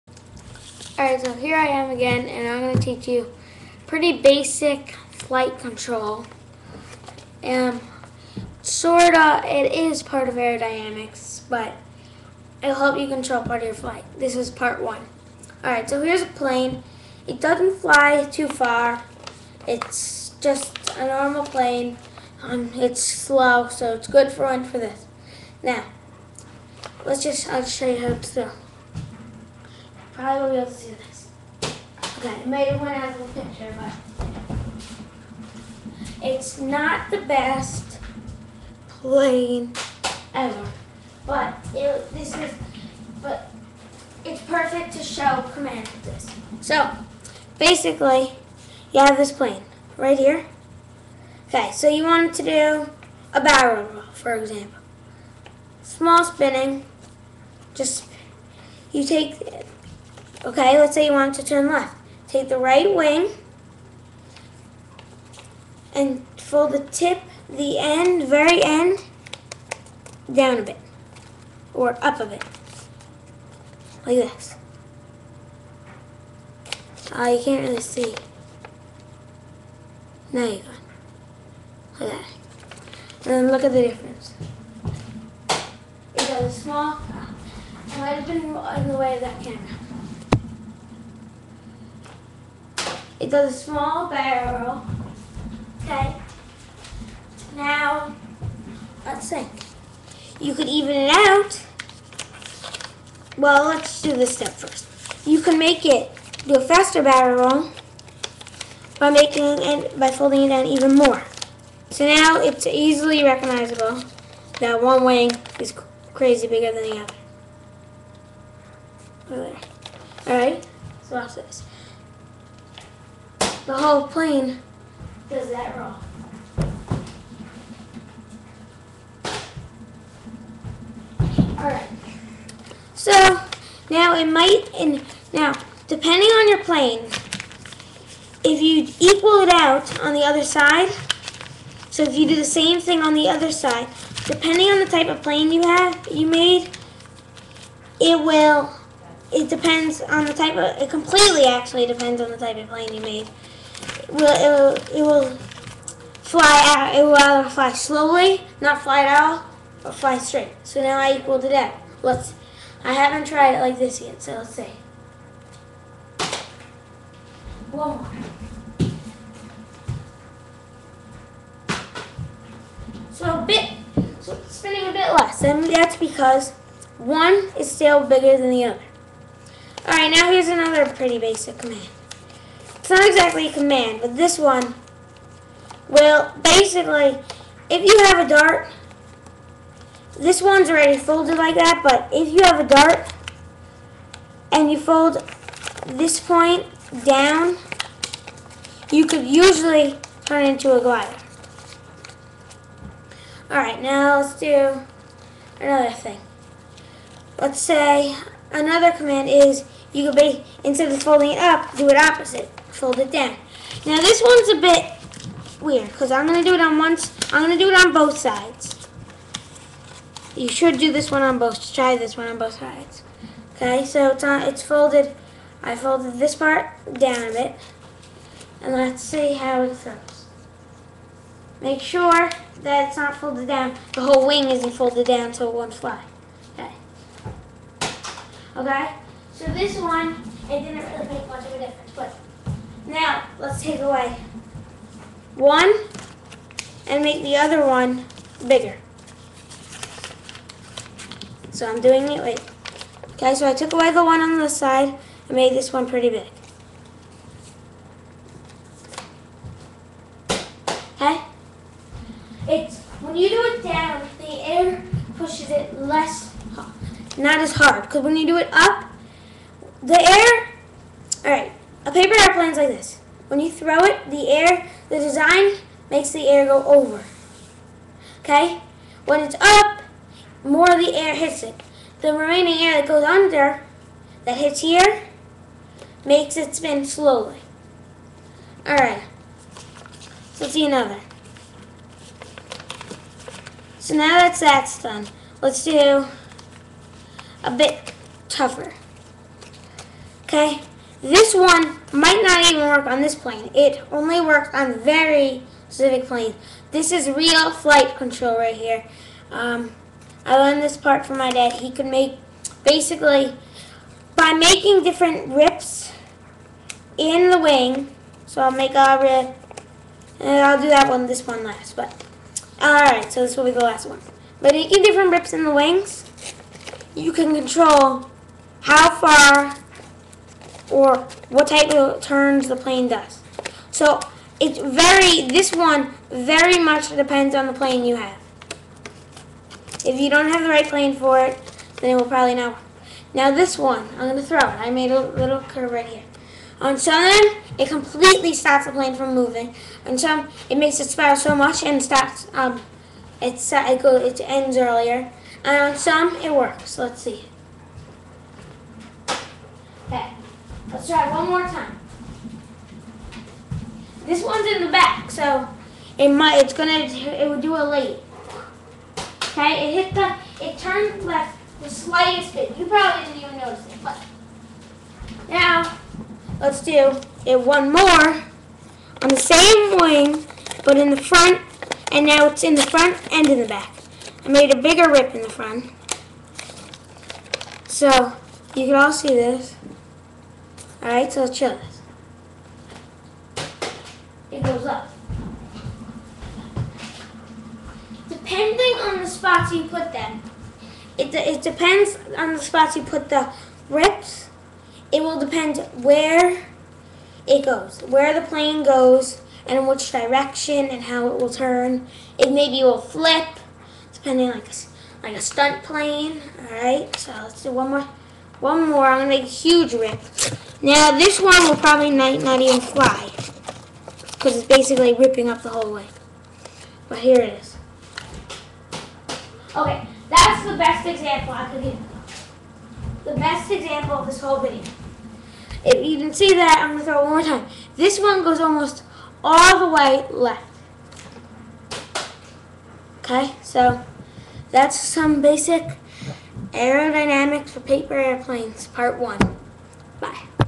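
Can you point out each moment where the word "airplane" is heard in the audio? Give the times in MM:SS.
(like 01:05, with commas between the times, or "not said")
04:32, 07:27.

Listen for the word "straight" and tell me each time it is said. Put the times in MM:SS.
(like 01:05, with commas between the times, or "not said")
02:40.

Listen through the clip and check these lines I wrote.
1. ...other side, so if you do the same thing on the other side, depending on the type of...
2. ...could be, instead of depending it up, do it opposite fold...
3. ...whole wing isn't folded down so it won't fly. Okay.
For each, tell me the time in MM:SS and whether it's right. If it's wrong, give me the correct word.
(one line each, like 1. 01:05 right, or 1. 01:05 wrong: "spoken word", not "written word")
1. 02:20 right
2. 03:30 wrong: "folding", not "depending"
3. 03:54 right.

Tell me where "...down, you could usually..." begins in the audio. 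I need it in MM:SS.
03:17.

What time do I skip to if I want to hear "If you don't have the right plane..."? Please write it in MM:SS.
05:39.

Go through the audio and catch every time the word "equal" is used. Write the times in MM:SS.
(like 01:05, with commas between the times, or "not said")
02:18, 02:41.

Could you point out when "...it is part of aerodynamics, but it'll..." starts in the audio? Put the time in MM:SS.
00:09.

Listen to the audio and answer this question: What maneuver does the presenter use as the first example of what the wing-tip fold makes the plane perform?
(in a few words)
A barrel roll.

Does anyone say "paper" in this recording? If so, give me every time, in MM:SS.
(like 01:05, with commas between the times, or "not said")
04:31, 07:27.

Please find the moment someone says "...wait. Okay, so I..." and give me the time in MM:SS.
04:12.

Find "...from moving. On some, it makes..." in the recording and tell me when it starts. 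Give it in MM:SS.
05:48.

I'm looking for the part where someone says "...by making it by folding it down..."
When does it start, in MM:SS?
01:48.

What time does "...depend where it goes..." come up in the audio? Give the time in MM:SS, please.
06:45.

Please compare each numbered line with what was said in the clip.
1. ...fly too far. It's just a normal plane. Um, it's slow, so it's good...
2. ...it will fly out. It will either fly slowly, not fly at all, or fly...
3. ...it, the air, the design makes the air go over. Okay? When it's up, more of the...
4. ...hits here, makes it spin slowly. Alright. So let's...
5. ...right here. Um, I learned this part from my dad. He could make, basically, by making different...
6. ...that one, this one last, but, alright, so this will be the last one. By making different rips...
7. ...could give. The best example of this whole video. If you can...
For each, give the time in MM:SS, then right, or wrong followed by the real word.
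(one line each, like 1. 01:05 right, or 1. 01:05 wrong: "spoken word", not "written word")
1. 00:17 right
2. 02:34 right
3. 04:33 right
4. 04:44 right
5. 05:08 right
6. 05:20 right
7. 07:11 right.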